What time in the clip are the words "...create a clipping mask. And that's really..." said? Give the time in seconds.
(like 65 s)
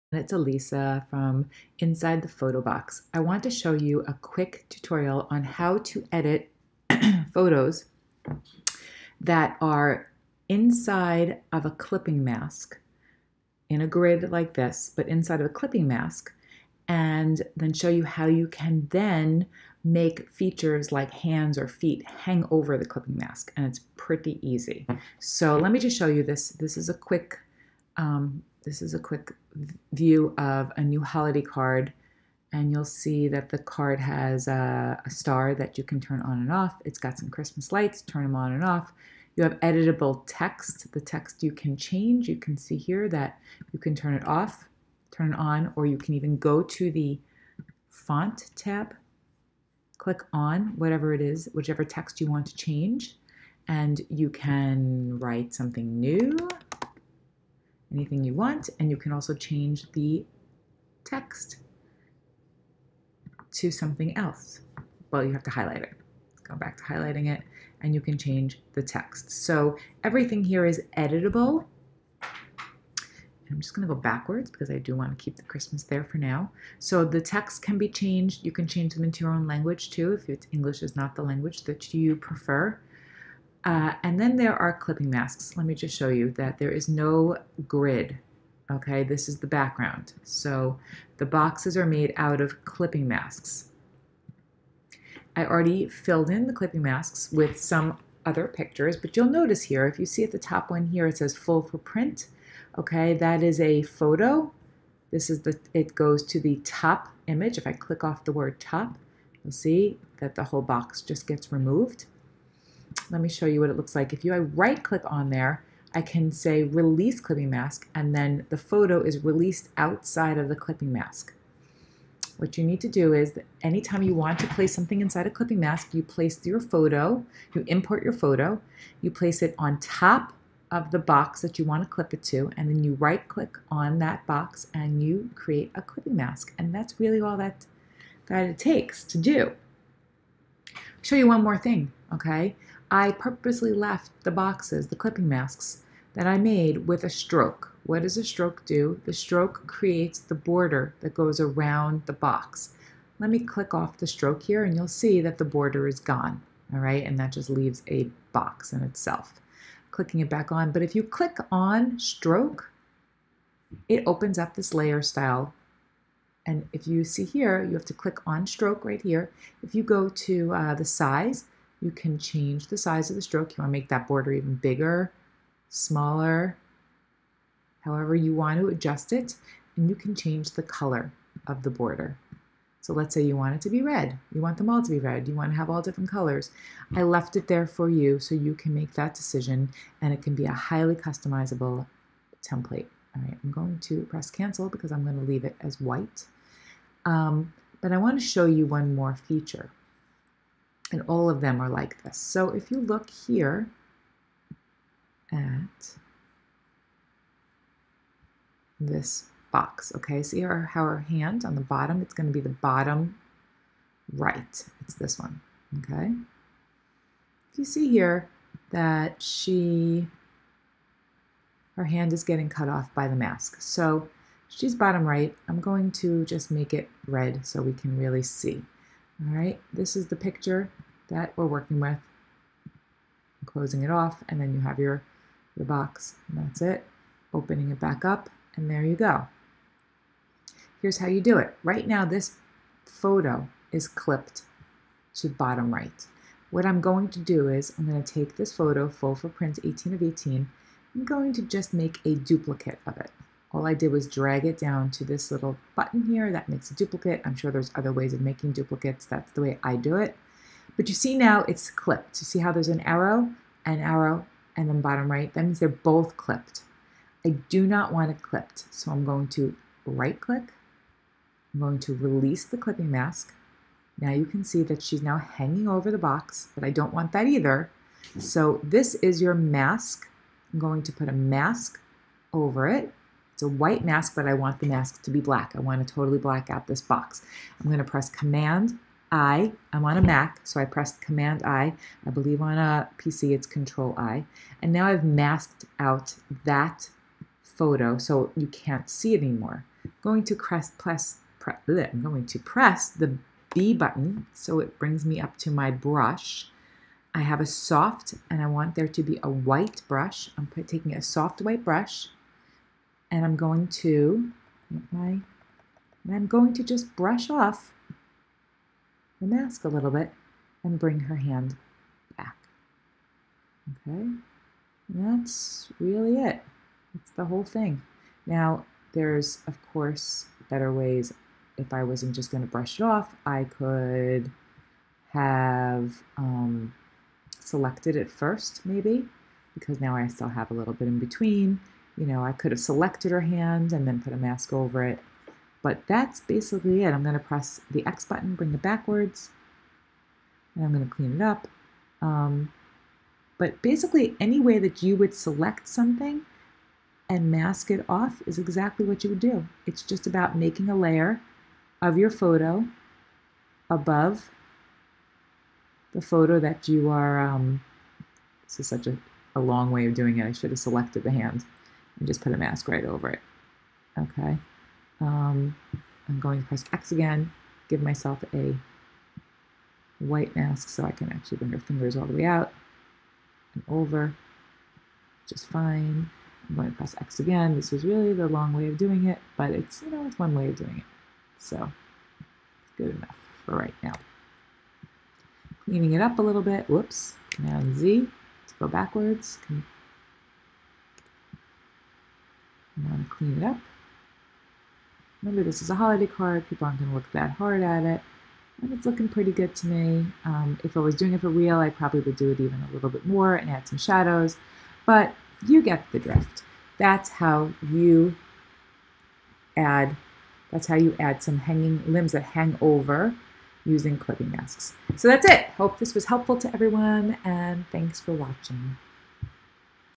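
135 s.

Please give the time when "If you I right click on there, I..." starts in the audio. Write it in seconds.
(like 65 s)
114 s.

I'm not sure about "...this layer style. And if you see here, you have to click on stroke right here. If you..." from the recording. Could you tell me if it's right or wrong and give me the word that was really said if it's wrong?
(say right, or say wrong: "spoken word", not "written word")
right.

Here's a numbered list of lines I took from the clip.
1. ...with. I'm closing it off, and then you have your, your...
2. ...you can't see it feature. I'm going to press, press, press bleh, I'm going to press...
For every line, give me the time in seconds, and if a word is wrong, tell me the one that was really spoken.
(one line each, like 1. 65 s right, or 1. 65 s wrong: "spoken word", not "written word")
1. 231 s right
2. 298 s wrong: "anymore", not "feature".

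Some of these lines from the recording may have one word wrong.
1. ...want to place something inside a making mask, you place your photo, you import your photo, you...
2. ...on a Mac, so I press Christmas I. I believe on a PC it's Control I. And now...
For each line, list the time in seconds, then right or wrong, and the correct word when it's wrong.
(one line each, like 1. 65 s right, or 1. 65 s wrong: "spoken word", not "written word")
1. 124 s wrong: "clipping", not "making"
2. 289 s wrong: "Command", not "Christmas".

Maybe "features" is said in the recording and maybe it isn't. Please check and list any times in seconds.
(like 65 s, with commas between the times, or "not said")
20 s, 199 s.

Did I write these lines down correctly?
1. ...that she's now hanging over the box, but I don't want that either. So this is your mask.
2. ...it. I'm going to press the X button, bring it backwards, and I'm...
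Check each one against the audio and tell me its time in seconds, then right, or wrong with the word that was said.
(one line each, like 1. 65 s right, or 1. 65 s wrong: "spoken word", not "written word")
1. 274 s right
2. 346 s right.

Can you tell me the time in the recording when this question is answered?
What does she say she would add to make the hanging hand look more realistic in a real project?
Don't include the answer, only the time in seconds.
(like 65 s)
413 s.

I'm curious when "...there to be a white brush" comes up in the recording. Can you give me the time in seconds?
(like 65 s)
308 s.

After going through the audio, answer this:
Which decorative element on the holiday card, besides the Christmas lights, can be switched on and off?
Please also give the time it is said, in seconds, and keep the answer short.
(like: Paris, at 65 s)
A star, at 35 s.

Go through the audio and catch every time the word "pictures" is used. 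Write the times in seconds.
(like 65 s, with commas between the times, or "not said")
98 s, 230 s.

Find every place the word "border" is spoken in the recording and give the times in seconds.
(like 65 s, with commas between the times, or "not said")
150 s, 155 s, 174 s, 181 s.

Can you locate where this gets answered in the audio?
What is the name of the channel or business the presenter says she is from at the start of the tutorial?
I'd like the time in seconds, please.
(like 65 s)
1 s.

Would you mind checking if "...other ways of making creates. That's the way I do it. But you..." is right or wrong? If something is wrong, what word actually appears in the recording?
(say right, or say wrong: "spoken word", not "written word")
wrong: "duplicates", not "creates".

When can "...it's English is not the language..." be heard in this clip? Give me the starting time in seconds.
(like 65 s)
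80 s.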